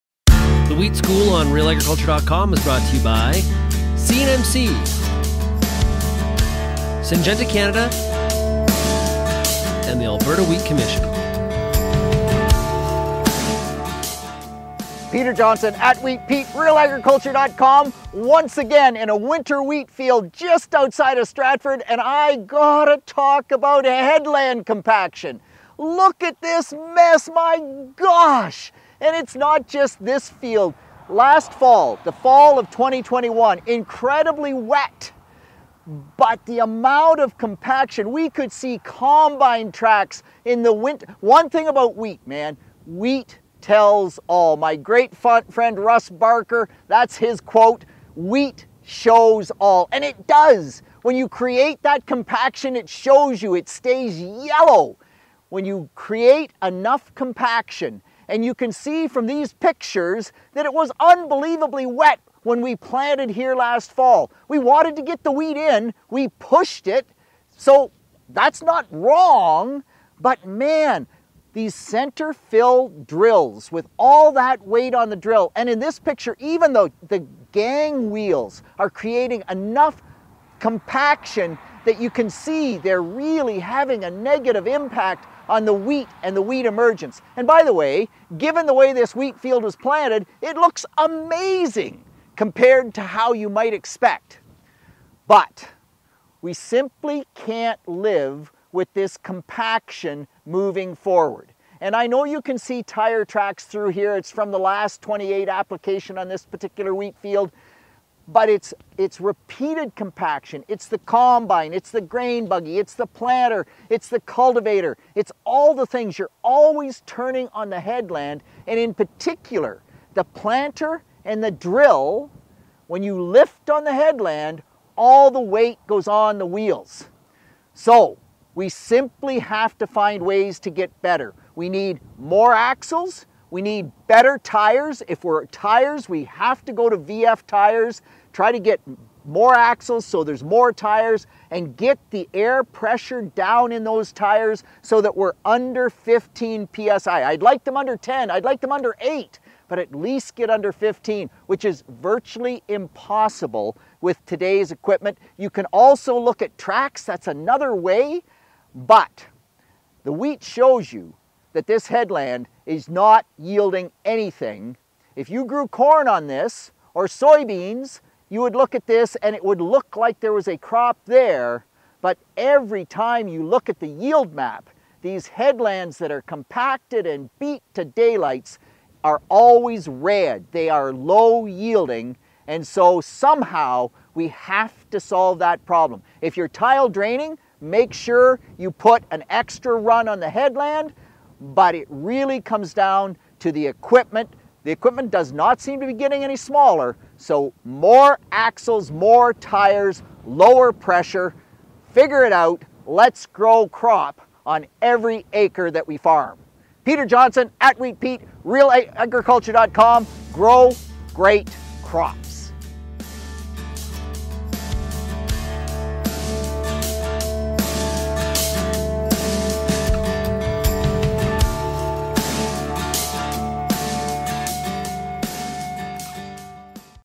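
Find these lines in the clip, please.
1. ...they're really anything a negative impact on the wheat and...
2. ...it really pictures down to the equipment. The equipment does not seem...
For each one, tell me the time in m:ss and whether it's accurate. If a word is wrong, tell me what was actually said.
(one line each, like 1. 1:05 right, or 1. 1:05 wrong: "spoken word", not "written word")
1. 1:22 wrong: "having", not "anything"
2. 3:11 wrong: "comes", not "pictures".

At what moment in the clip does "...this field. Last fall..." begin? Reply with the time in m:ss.
0:30.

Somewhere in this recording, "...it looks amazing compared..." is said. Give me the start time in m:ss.
1:30.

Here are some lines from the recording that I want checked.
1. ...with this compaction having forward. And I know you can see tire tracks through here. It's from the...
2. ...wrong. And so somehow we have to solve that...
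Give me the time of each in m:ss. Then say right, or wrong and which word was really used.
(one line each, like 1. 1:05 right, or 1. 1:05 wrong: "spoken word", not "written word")
1. 1:38 wrong: "moving", not "having"
2. 3:01 wrong: "yielding", not "wrong".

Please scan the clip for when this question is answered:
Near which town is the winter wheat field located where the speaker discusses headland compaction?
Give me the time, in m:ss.
0:21.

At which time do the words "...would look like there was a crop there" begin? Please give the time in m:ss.
2:49.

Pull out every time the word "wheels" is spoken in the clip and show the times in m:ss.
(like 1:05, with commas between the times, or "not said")
1:18, 2:06.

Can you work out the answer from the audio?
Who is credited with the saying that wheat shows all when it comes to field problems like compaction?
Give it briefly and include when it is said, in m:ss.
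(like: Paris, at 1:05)
Russ Barker, at 0:45.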